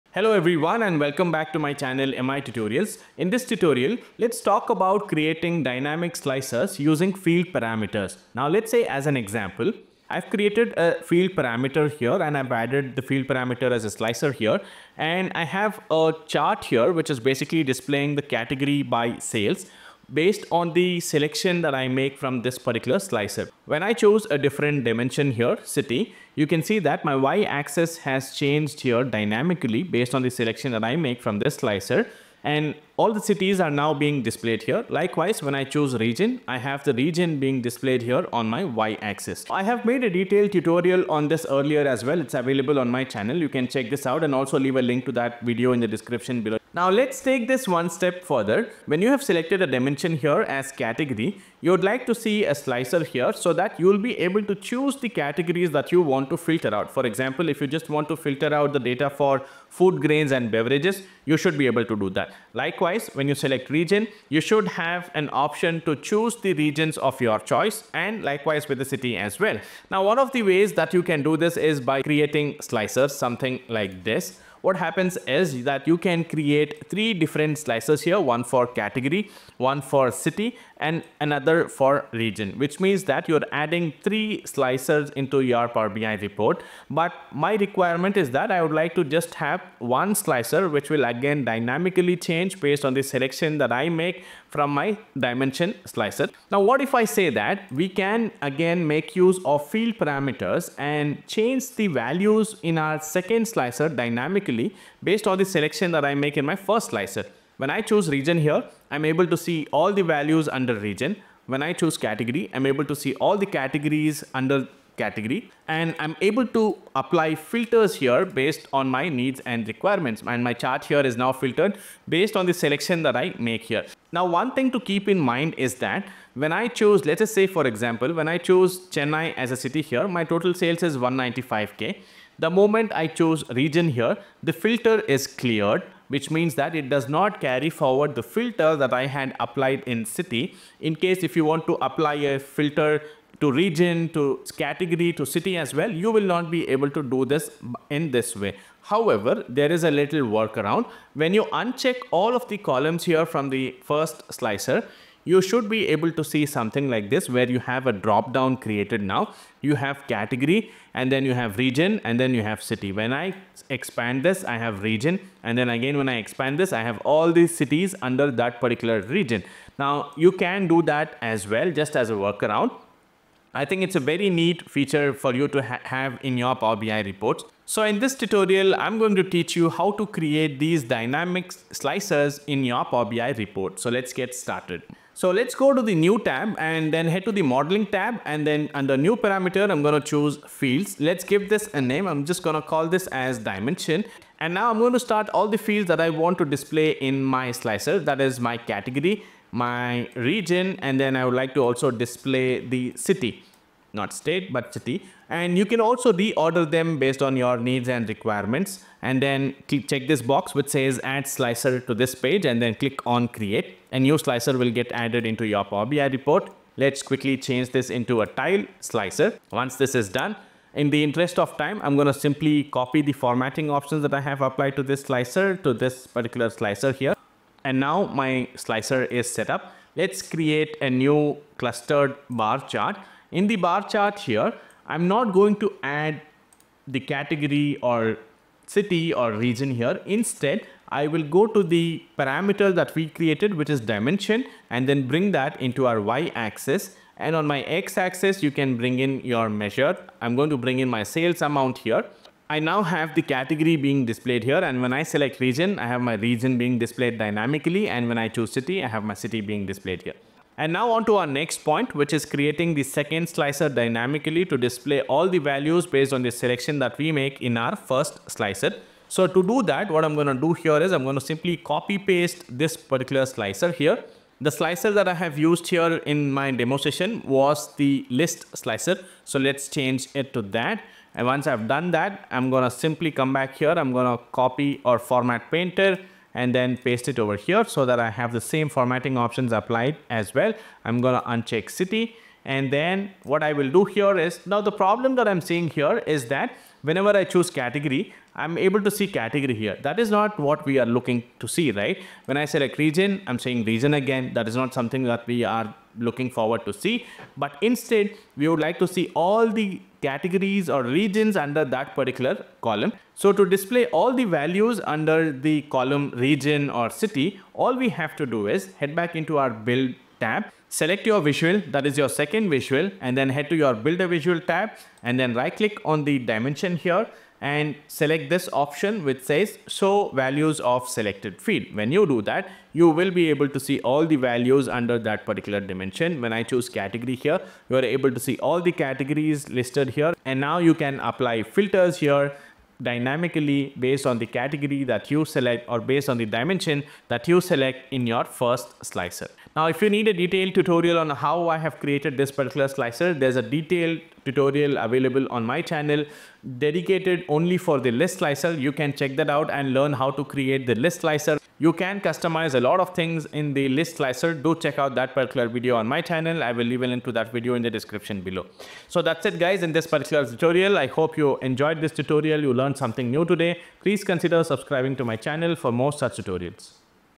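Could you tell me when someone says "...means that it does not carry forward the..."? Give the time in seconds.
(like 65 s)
136 s.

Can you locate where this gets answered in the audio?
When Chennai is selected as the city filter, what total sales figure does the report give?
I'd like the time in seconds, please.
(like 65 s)
130 s.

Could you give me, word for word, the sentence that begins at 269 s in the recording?
So to do that, what I'm going to do here is I'm going to simply copy paste this particular slicer here.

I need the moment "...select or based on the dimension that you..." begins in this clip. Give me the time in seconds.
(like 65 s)
345 s.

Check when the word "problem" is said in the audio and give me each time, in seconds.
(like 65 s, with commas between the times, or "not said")
294 s.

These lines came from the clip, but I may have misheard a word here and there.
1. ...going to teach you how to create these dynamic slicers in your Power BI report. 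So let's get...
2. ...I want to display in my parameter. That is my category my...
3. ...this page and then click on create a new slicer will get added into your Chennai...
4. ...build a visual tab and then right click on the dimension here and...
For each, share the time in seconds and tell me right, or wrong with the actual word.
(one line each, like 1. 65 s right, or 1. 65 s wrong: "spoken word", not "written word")
1. 178 s right
2. 195 s wrong: "slicer", not "parameter"
3. 211 s wrong: "Power", not "Chennai"
4. 323 s right.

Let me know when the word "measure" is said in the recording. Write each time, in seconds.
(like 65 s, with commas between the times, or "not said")
249 s.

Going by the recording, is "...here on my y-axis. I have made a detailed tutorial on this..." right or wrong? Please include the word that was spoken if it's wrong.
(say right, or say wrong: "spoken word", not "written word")
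right.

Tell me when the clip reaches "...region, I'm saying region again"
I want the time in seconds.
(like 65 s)
302 s.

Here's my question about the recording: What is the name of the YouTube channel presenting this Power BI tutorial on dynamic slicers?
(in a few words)
MI Tutorials.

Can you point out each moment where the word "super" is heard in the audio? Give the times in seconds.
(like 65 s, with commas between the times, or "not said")
not said.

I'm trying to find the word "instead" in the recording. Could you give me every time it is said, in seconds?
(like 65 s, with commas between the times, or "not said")
240 s, 307 s.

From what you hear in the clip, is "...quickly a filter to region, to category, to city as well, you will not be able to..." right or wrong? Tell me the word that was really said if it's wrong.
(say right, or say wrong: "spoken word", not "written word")
wrong: "apply", not "quickly".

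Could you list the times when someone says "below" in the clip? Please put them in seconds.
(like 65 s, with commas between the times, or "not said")
46 s, 368 s.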